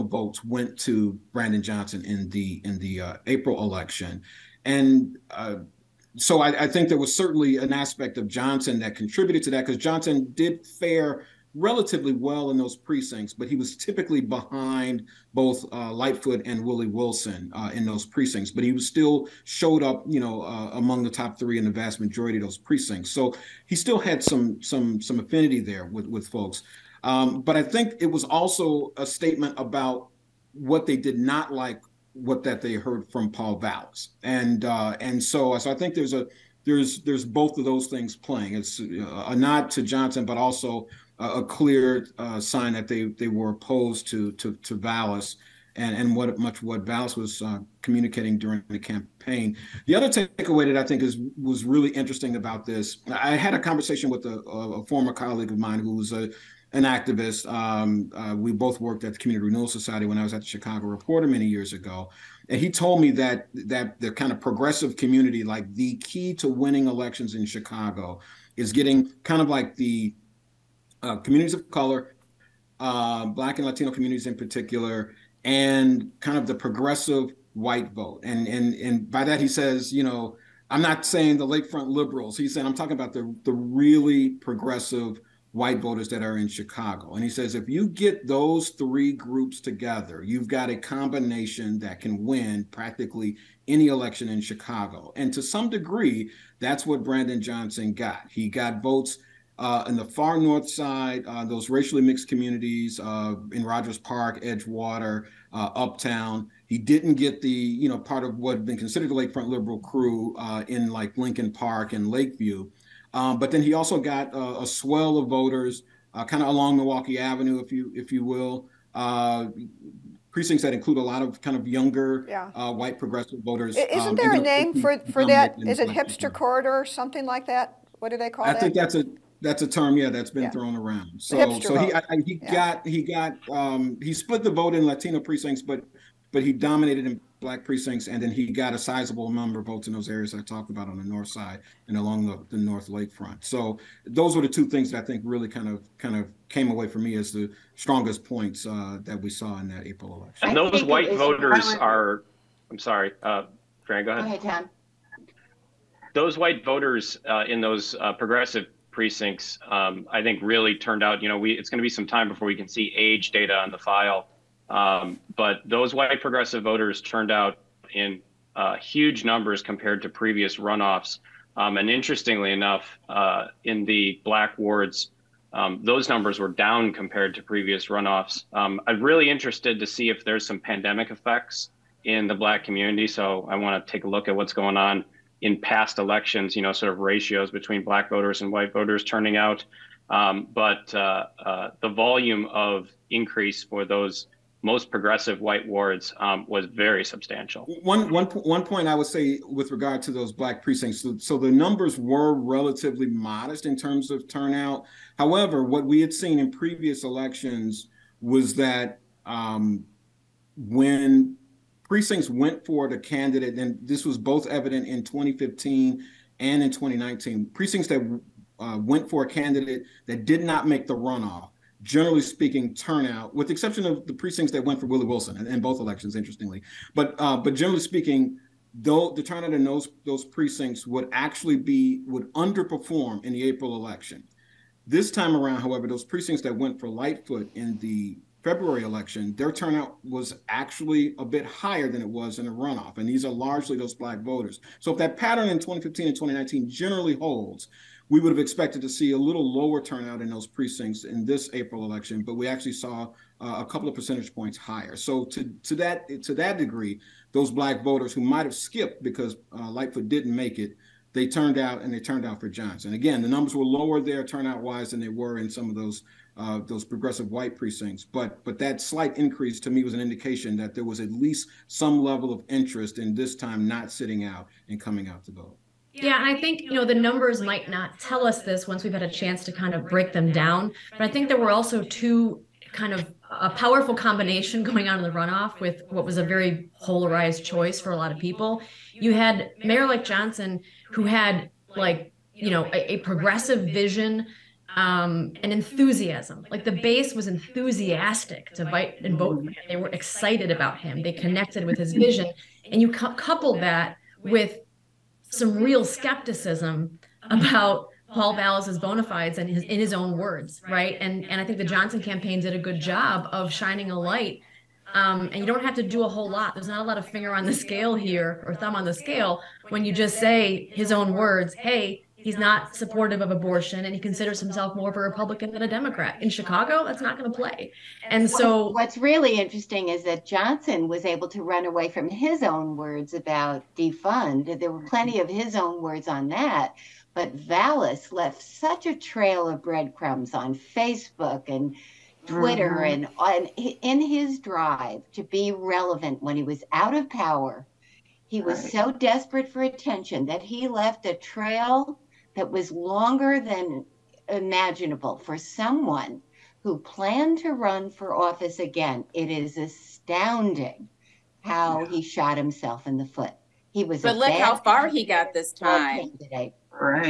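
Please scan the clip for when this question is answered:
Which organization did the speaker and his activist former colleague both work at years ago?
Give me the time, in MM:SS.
00:59.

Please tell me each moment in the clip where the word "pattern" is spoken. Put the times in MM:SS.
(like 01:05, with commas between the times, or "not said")
04:05.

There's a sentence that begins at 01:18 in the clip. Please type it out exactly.
And and and by that he says, you know, I'm not saying the lakefront liberals.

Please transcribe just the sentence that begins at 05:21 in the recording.
Hey, He's not supportive of abortion and he considers himself more of a Republican than a Democrat.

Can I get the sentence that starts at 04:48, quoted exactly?
You had Mayor like Johnson, who had like you know a, a progressive vision um, and enthusiasm.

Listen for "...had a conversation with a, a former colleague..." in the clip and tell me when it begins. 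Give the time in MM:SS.
00:53.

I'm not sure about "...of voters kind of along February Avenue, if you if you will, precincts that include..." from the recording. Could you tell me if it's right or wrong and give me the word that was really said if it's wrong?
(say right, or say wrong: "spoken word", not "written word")
wrong: "Milwaukee", not "February".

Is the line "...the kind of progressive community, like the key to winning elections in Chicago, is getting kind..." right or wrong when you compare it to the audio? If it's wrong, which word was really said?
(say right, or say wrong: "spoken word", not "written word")
right.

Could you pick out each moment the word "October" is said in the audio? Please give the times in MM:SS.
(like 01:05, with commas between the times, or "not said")
not said.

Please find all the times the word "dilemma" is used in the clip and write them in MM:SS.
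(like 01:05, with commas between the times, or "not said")
not said.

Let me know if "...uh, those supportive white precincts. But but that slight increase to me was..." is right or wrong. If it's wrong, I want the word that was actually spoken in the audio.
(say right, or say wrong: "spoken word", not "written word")
wrong: "progressive", not "supportive".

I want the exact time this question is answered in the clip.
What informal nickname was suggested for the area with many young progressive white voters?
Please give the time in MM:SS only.
02:05.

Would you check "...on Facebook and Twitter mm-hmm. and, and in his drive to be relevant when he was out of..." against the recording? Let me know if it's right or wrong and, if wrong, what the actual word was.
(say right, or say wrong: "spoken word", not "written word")
right.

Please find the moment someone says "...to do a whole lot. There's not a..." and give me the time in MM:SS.
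05:15.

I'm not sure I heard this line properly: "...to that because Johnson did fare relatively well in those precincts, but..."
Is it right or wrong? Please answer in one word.
right.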